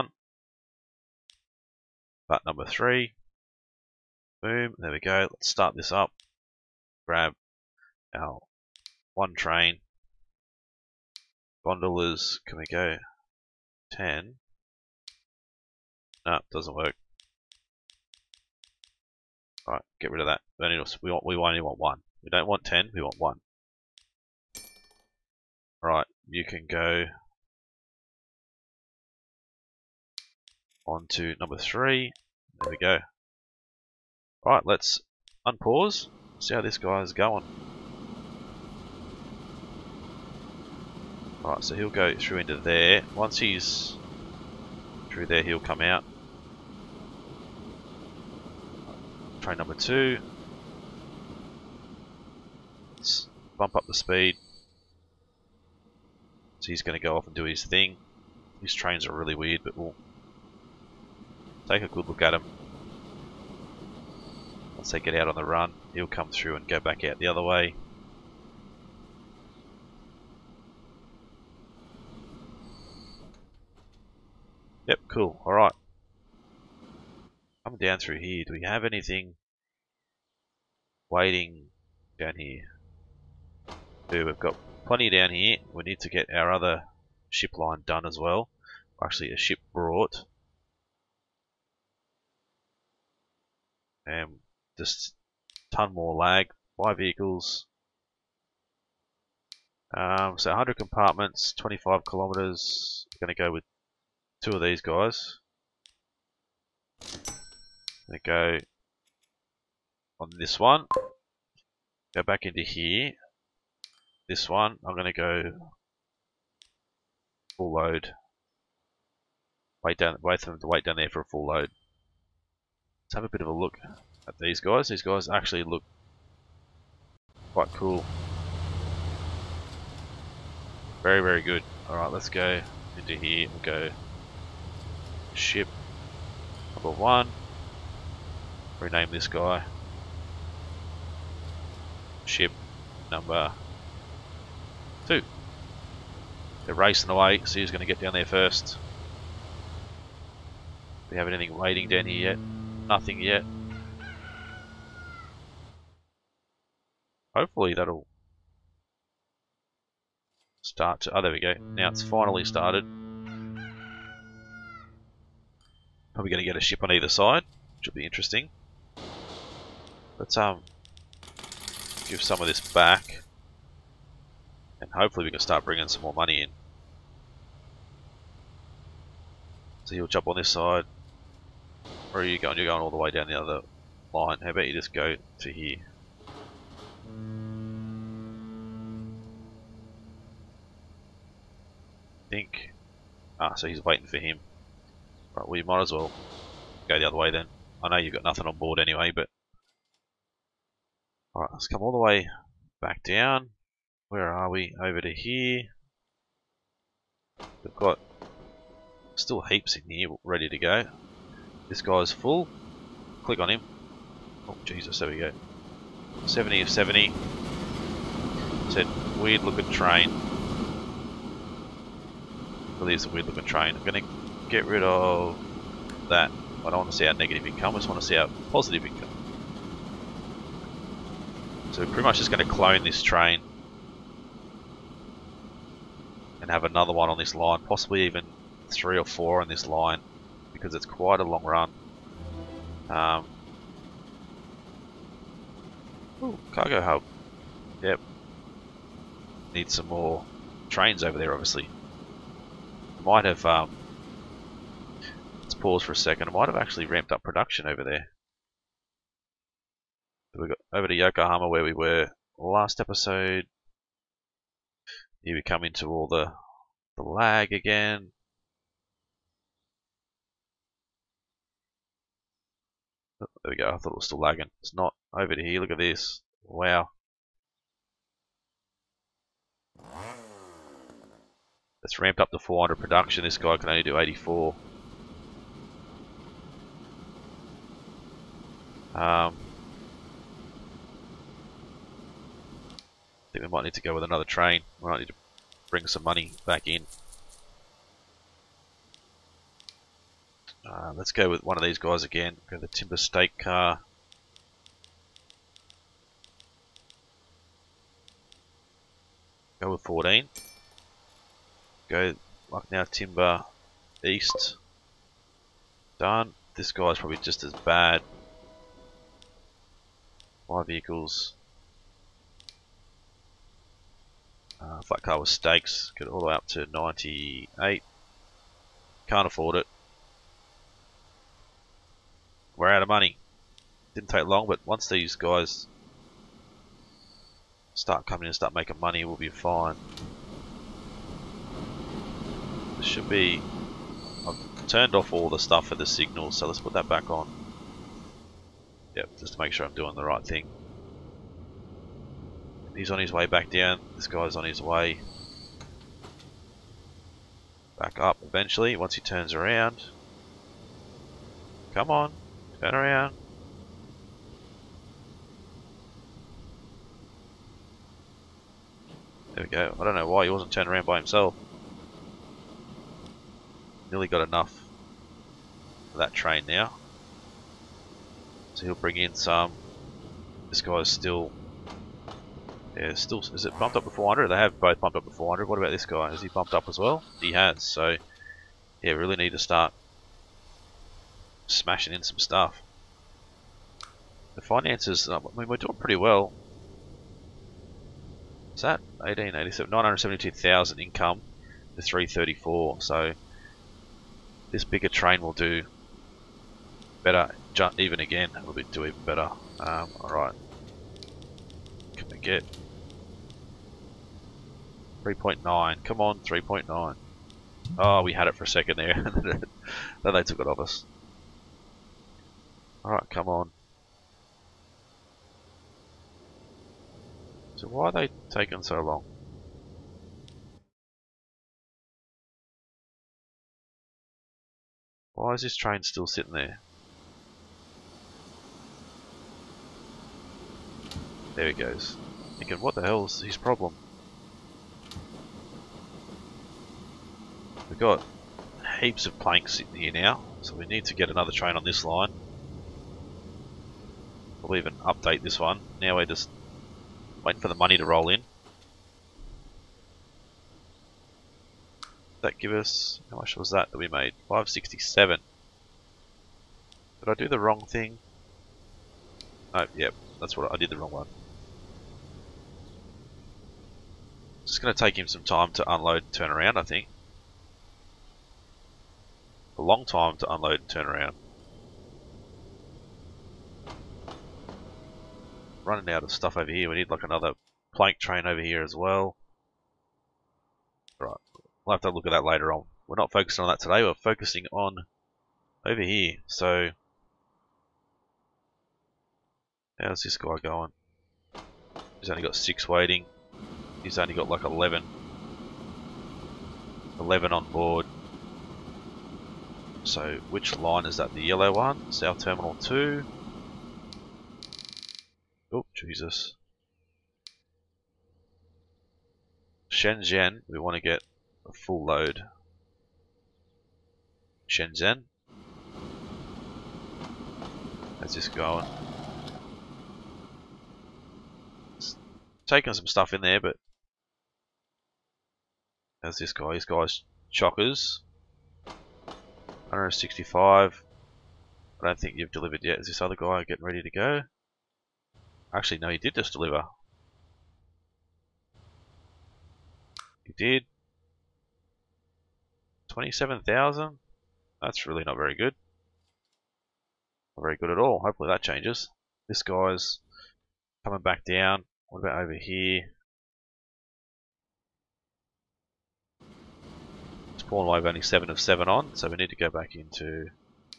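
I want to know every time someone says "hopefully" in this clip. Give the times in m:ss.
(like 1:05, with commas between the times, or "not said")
2:37, 2:54, 9:18.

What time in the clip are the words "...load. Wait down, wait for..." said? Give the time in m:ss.
1:57.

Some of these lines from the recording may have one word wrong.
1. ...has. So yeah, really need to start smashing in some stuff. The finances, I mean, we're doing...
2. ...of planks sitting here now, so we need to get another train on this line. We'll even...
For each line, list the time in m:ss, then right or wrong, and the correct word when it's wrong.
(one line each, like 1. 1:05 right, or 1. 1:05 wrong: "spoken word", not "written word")
1. 6:27 right
2. 7:29 right.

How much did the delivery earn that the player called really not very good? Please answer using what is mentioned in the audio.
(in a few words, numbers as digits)
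27,000.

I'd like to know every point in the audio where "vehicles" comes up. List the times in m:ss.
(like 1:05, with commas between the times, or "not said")
1:36, 5:20.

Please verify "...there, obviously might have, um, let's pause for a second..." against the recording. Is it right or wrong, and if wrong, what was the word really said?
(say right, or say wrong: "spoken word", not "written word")
right.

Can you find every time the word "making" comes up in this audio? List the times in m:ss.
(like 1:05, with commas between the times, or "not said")
5:38.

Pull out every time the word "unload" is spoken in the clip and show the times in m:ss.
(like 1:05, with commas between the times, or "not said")
7:55, 8:00.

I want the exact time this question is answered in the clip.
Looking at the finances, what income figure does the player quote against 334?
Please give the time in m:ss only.
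6:39.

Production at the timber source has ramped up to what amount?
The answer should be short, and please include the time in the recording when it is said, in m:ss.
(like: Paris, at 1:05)
400, at 4:42.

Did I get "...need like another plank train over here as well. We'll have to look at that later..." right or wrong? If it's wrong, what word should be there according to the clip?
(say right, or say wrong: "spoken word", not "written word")
right.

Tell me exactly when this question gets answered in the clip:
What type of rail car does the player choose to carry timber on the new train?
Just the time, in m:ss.
5:02.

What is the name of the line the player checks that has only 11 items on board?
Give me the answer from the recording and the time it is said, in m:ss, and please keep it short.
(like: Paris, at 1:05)
South Terminal 2, at 8:31.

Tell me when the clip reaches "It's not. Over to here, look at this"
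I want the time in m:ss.
4:34.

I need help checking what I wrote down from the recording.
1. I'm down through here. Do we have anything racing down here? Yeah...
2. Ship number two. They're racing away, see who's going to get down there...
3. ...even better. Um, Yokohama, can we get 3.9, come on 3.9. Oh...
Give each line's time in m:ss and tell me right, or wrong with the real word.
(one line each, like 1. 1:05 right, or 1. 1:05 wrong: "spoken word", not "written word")
1. 1:17 wrong: "waiting", not "racing"
2. 2:22 right
3. 6:48 wrong: "Alright", not "Yokohama".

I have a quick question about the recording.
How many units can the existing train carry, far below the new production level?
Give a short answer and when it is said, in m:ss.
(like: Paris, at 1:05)
84, at 4:43.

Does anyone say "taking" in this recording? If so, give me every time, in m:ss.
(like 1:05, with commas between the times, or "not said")
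7:08, 8:52.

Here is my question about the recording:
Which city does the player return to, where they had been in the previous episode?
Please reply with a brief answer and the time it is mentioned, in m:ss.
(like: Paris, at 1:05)
Yokohama, at 4:20.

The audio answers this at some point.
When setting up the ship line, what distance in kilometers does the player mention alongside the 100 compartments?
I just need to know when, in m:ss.
1:41.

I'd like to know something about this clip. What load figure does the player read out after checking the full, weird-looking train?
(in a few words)
70 of 70.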